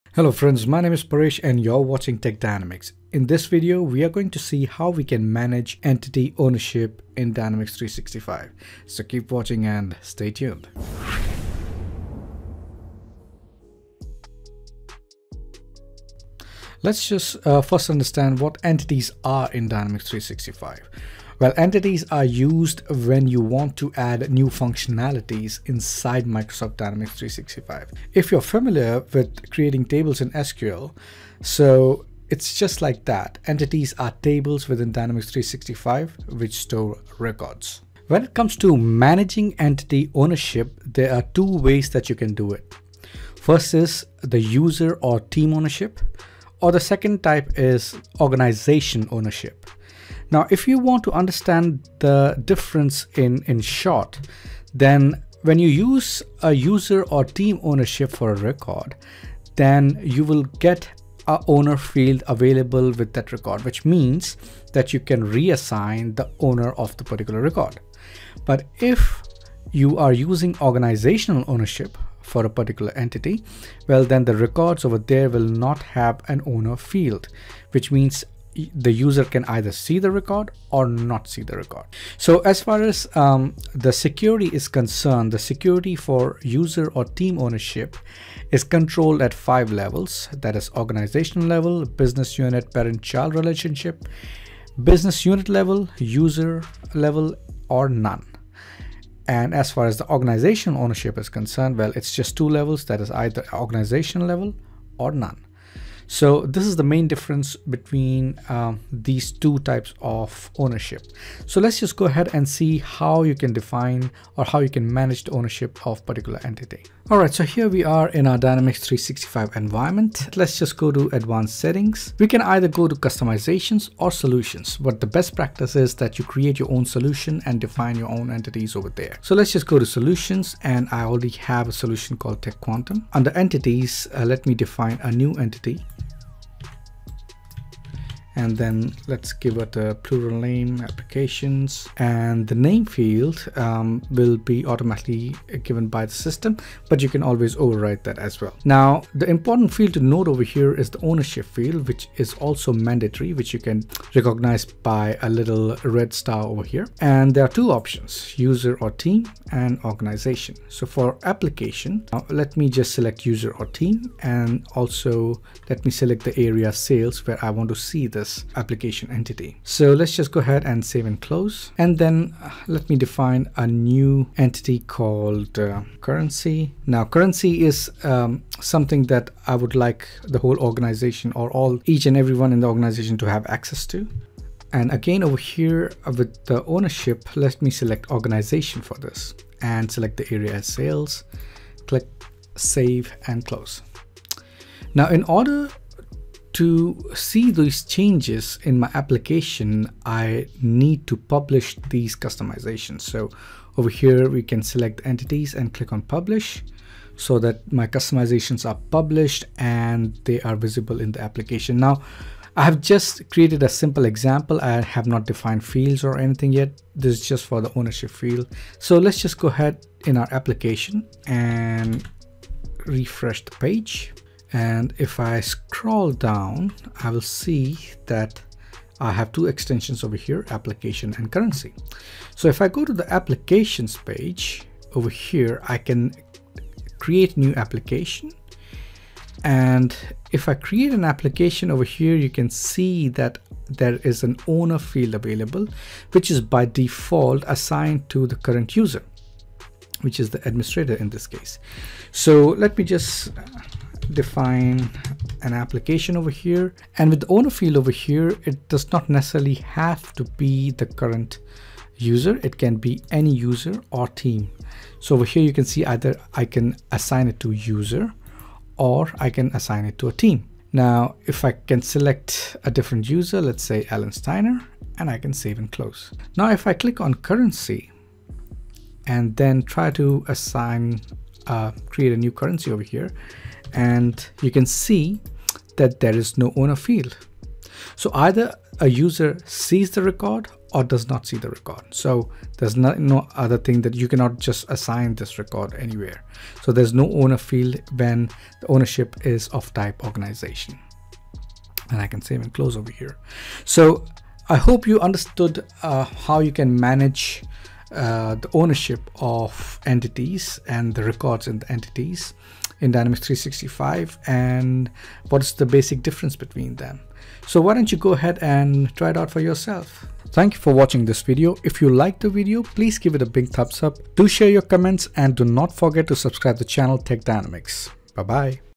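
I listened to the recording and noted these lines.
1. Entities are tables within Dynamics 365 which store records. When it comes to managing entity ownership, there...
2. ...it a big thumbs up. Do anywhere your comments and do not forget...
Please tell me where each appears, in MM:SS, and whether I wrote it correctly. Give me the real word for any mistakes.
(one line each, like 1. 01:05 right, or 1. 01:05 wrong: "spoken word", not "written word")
1. 00:33 right
2. 05:23 wrong: "share", not "anywhere".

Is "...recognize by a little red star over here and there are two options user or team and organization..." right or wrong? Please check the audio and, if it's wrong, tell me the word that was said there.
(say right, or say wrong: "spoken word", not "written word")
right.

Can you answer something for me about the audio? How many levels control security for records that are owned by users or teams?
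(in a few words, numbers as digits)
5.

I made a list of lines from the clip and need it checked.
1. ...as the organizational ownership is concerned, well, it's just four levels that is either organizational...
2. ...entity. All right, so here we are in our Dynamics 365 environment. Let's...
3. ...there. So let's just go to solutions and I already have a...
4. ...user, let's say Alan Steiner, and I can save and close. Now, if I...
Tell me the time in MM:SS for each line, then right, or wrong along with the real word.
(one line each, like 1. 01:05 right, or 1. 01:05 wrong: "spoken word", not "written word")
1. 01:39 wrong: "two", not "four"
2. 01:56 right
3. 02:08 right
4. 04:33 right.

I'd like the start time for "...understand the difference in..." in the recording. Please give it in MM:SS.
00:51.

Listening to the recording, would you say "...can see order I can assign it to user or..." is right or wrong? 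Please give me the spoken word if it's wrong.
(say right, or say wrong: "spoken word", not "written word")
wrong: "either", not "order".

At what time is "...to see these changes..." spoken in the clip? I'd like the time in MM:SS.
03:16.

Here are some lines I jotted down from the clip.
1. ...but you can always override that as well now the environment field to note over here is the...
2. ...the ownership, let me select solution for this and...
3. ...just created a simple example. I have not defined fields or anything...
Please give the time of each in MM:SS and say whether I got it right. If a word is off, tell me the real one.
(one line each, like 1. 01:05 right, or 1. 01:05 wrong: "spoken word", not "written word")
1. 02:26 wrong: "important", not "environment"
2. 03:06 wrong: "organization", not "solution"
3. 03:32 right.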